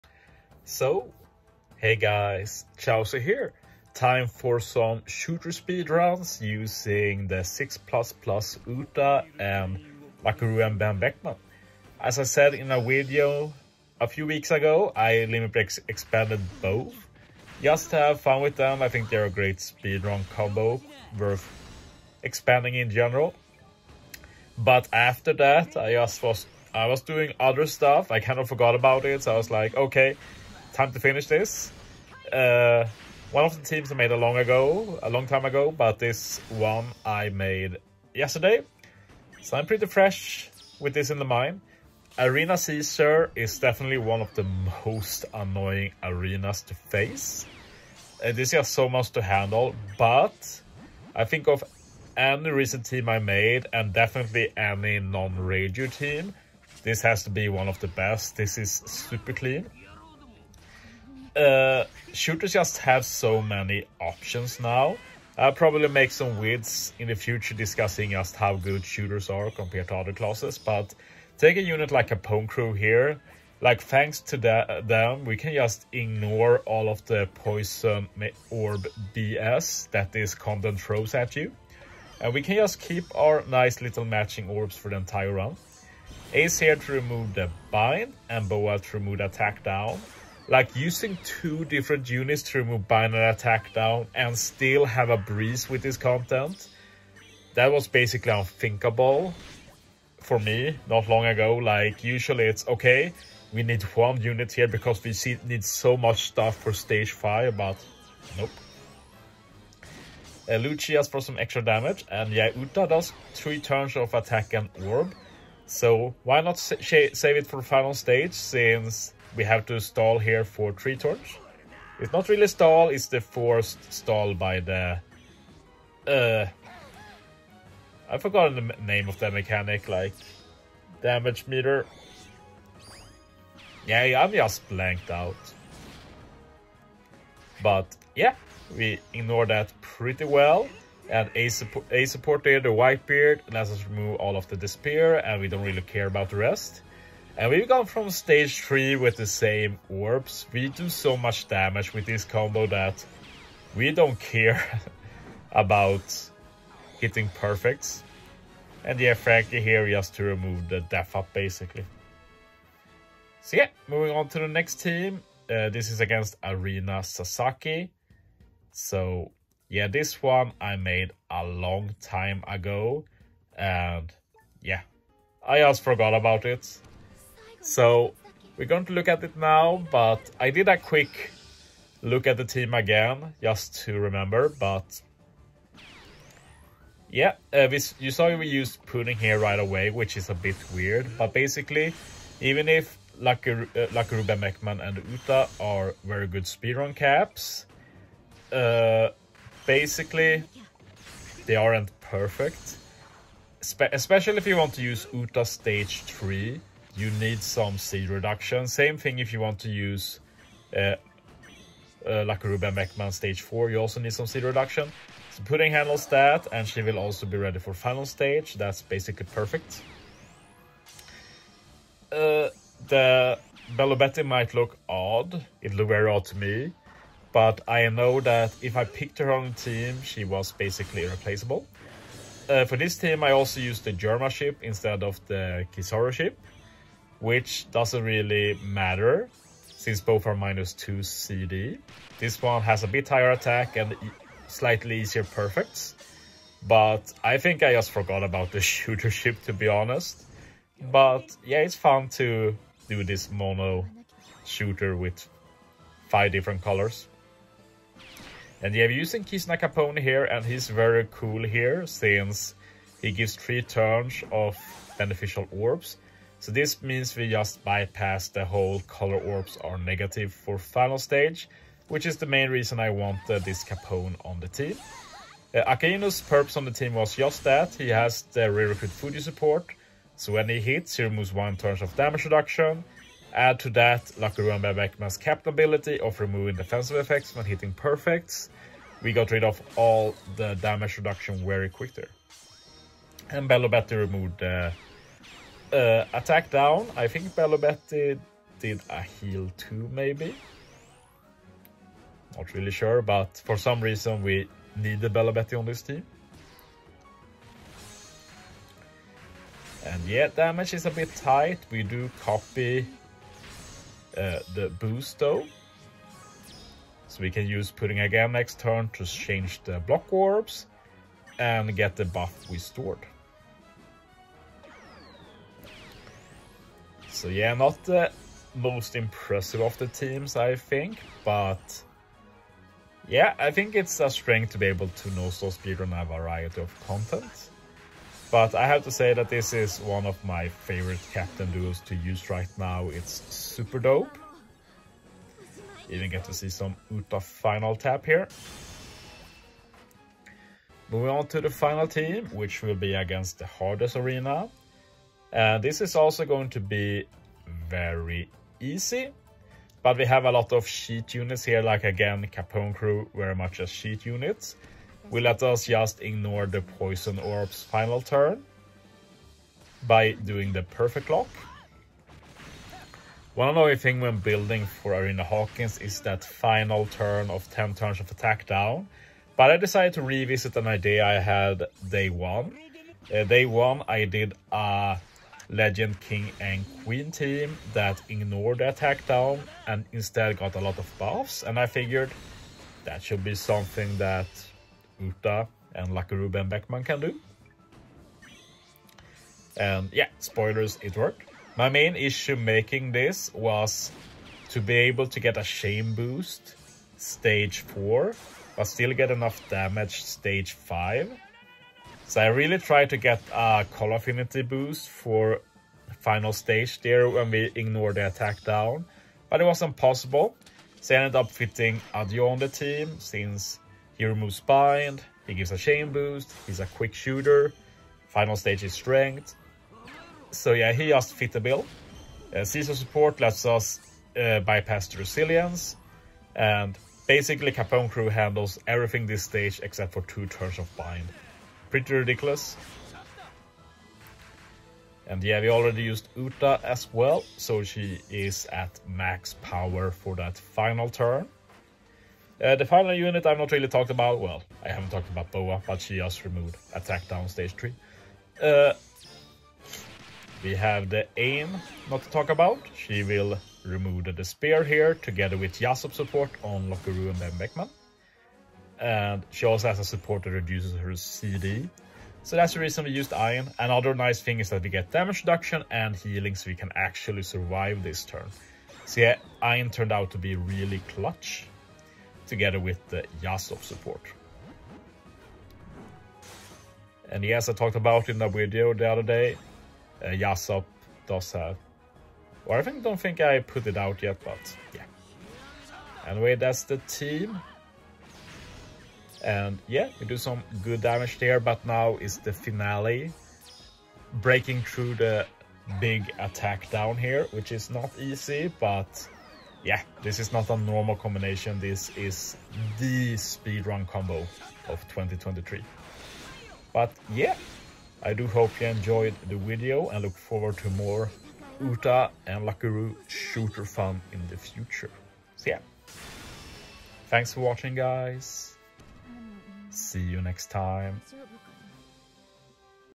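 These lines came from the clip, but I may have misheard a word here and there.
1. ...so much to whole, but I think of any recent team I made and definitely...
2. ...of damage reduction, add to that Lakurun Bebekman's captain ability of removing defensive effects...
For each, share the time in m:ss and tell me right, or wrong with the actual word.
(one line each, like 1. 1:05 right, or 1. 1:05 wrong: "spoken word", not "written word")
1. 0:48 wrong: "handle", not "whole"
2. 4:41 right.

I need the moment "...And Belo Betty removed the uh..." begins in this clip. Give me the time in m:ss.
4:53.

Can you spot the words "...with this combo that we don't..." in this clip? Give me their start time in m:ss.
2:31.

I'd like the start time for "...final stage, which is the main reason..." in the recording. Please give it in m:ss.
4:30.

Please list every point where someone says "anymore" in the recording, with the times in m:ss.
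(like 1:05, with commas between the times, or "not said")
not said.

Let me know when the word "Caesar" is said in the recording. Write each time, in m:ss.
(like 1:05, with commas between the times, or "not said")
0:42, 7:12.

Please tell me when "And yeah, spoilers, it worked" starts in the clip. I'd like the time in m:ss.
6:39.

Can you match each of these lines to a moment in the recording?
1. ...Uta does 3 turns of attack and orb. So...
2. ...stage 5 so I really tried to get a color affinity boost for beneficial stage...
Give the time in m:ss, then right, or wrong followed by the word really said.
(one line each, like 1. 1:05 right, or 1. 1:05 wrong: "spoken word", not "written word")
1. 1:52 right
2. 6:50 wrong: "final", not "beneficial".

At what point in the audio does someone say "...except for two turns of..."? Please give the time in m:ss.
7:19.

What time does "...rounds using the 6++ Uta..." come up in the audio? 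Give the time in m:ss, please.
0:05.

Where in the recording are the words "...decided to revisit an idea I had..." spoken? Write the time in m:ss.
6:19.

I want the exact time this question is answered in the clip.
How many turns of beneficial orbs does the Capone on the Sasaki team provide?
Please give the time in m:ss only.
4:23.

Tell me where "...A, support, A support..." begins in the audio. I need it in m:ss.
2:21.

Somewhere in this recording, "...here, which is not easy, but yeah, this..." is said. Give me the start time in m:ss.
8:26.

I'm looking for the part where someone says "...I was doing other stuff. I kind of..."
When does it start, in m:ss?
0:26.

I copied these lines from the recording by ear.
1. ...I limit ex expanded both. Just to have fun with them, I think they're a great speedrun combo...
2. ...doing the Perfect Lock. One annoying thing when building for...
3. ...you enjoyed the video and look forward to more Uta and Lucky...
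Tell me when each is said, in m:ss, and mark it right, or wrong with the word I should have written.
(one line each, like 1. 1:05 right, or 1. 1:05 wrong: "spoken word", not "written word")
1. 0:14 right
2. 6:10 right
3. 8:38 right.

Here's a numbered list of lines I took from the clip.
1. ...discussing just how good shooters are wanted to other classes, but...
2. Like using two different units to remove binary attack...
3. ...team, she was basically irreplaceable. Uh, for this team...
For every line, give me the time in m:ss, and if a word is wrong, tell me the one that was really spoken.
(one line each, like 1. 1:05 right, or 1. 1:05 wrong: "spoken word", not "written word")
1. 1:07 wrong: "compared", not "wanted"
2. 1:30 right
3. 3:49 right.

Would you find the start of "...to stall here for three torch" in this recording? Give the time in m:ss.
1:59.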